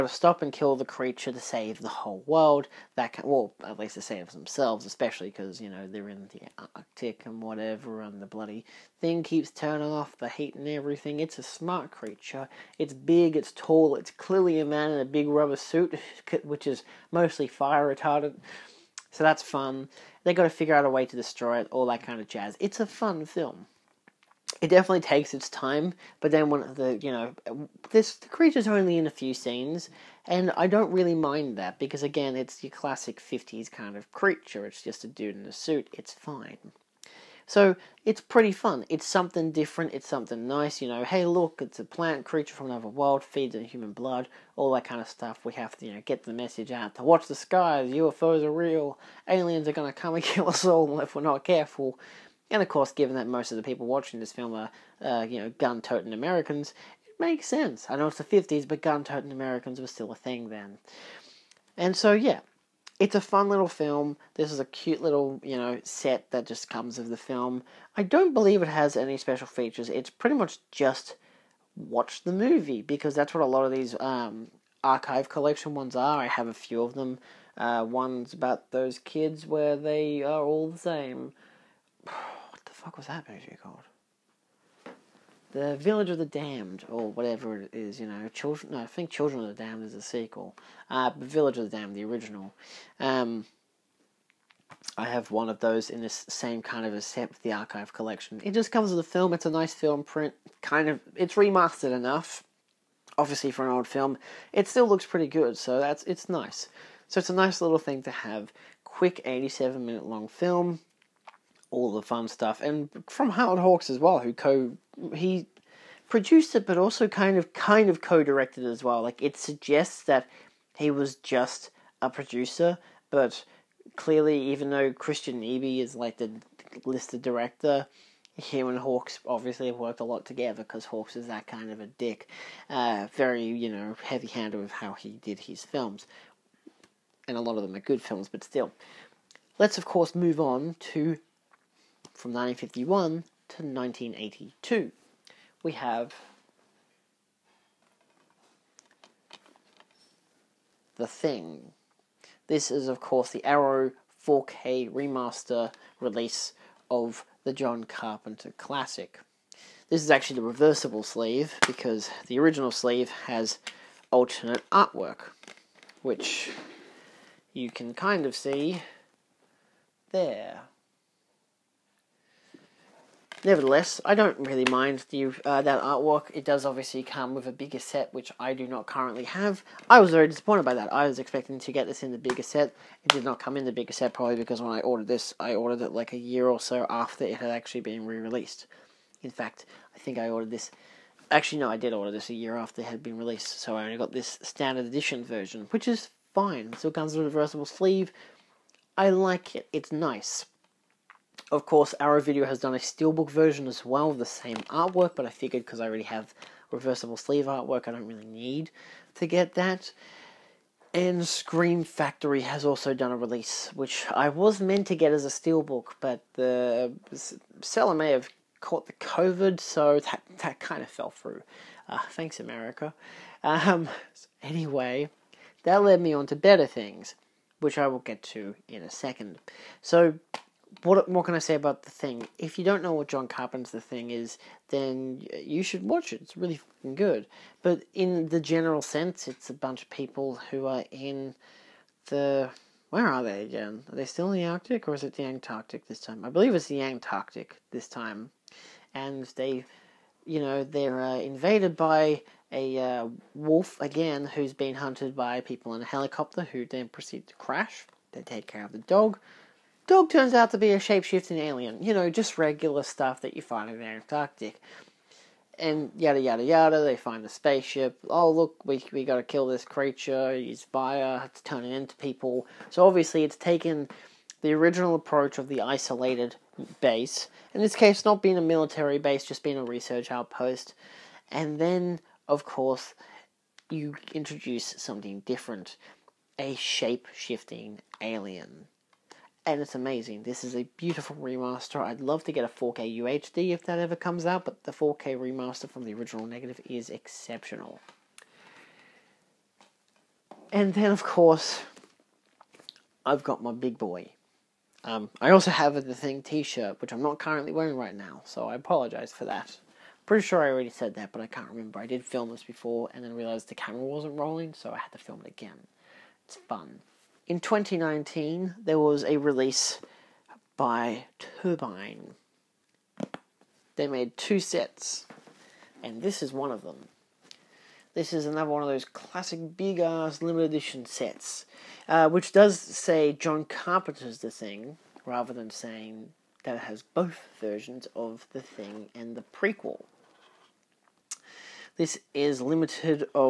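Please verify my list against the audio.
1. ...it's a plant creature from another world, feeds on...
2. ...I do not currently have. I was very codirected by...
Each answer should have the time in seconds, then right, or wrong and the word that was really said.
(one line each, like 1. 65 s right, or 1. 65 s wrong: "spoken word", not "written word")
1. 41 s right
2. 178 s wrong: "disappointed", not "codirected".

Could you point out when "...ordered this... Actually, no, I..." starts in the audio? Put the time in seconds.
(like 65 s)
190 s.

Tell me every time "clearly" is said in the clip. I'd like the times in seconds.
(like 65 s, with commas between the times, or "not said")
14 s, 123 s.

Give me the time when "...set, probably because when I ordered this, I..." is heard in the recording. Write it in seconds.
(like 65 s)
183 s.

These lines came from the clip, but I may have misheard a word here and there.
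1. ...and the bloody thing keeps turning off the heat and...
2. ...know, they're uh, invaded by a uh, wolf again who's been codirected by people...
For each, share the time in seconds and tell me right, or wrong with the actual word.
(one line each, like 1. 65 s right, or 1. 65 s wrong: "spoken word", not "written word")
1. 8 s right
2. 250 s wrong: "hunted", not "codirected".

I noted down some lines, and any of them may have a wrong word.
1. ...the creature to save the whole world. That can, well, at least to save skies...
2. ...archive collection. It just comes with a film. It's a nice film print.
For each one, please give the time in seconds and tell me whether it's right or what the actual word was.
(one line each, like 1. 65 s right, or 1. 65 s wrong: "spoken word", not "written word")
1. 0 s wrong: "themselves", not "skies"
2. 97 s right.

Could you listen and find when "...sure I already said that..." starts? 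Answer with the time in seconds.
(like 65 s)
310 s.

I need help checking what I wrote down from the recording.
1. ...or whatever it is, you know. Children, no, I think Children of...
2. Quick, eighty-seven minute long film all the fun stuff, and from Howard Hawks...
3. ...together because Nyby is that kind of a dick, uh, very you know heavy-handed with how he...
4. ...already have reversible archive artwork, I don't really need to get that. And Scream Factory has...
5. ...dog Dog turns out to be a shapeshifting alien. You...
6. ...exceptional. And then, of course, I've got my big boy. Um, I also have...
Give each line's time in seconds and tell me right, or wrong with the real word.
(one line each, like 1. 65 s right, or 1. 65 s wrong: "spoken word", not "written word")
1. 86 s right
2. 108 s right
3. 130 s wrong: "Hawks", not "Nyby"
4. 205 s wrong: "sleeve", not "archive"
5. 258 s right
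6. 296 s right.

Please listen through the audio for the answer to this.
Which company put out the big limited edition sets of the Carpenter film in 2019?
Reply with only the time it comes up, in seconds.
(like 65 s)
321 s.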